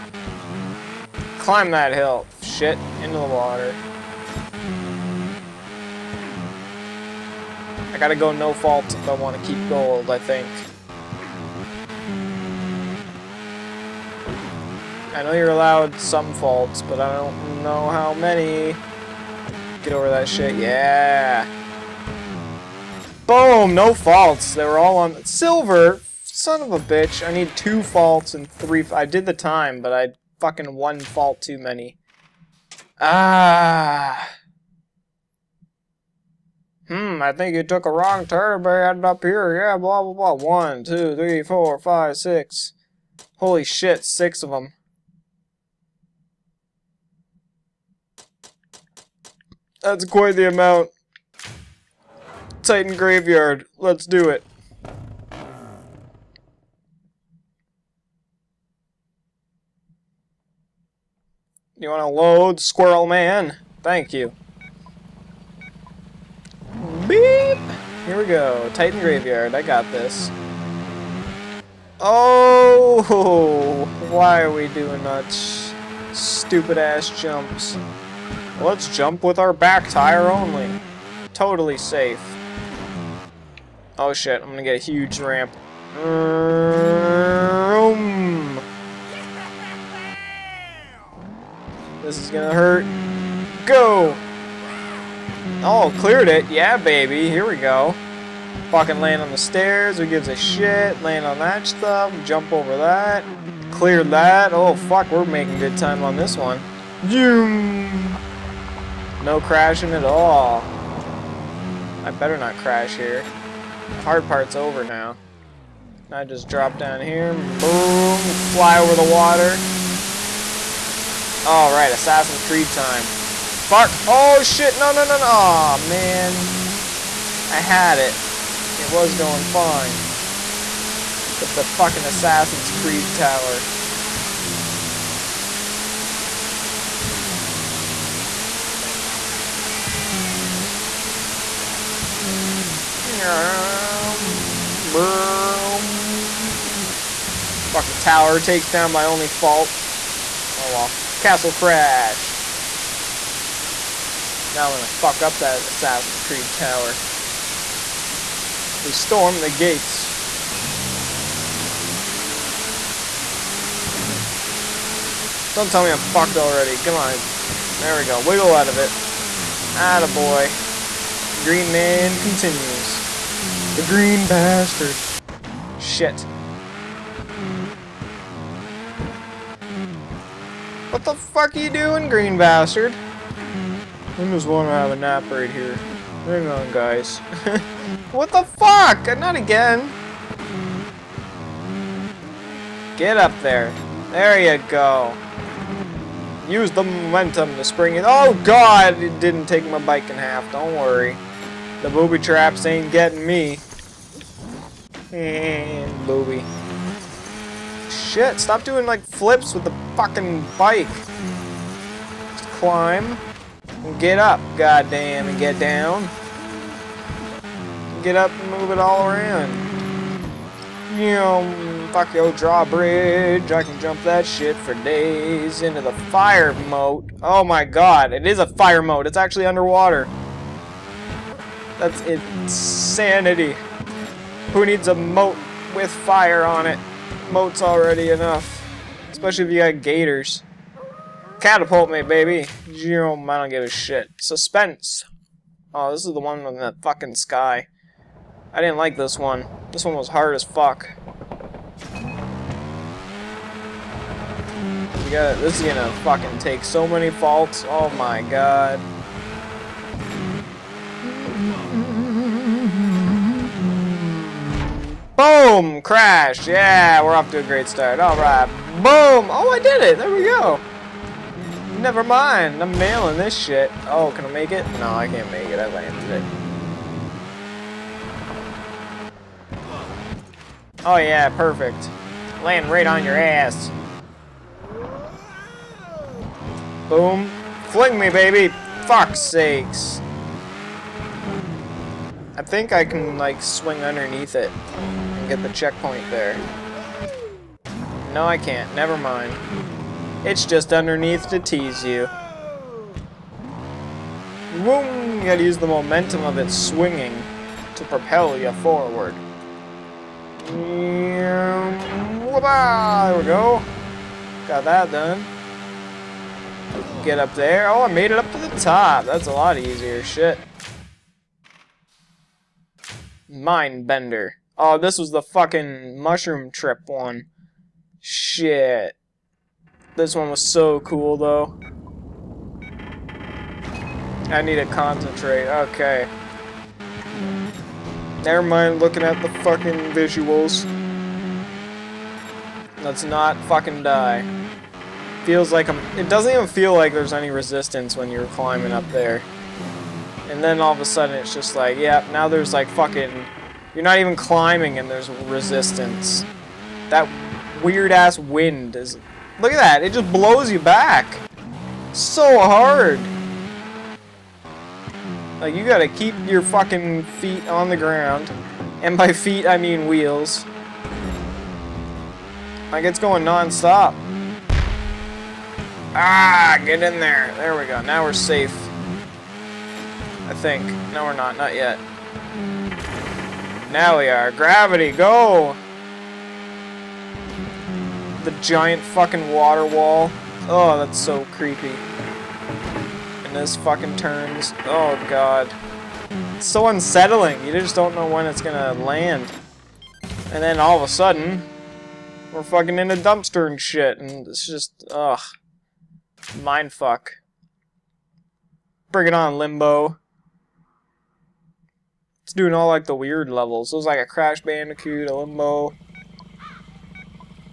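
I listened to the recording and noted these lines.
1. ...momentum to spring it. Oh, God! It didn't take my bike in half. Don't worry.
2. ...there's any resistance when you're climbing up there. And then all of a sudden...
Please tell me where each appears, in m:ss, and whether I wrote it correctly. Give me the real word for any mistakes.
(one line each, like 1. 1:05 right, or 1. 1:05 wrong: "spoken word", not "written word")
1. 3:16 right
2. 5:46 right.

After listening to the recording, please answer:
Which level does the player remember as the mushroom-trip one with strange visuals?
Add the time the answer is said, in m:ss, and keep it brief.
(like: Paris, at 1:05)
Mind Bender, at 5:23.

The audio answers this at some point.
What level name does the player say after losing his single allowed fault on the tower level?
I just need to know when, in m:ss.
2:31.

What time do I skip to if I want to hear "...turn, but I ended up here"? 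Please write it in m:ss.
0:38.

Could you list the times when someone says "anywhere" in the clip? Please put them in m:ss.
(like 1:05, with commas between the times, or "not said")
not said.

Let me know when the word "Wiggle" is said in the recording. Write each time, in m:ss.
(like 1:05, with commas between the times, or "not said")
2:48.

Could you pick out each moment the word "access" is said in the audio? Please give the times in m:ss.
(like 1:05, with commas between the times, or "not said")
not said.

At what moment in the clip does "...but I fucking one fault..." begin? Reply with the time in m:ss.
0:29.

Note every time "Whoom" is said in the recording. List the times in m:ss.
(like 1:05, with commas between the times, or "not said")
5:04.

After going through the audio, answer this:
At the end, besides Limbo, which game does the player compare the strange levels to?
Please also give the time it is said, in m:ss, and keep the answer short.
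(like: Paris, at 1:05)
Crash Bandicoot, at 6:54.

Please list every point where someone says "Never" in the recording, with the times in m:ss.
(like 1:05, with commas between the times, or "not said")
4:31, 4:58, 5:38.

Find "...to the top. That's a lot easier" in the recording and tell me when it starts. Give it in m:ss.
5:18.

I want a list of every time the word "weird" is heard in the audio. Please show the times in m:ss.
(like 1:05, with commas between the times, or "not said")
5:57, 6:52.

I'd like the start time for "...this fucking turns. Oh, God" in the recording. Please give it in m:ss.
6:33.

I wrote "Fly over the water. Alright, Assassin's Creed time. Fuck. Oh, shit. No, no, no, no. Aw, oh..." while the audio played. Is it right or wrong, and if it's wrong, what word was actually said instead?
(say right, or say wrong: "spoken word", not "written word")
right.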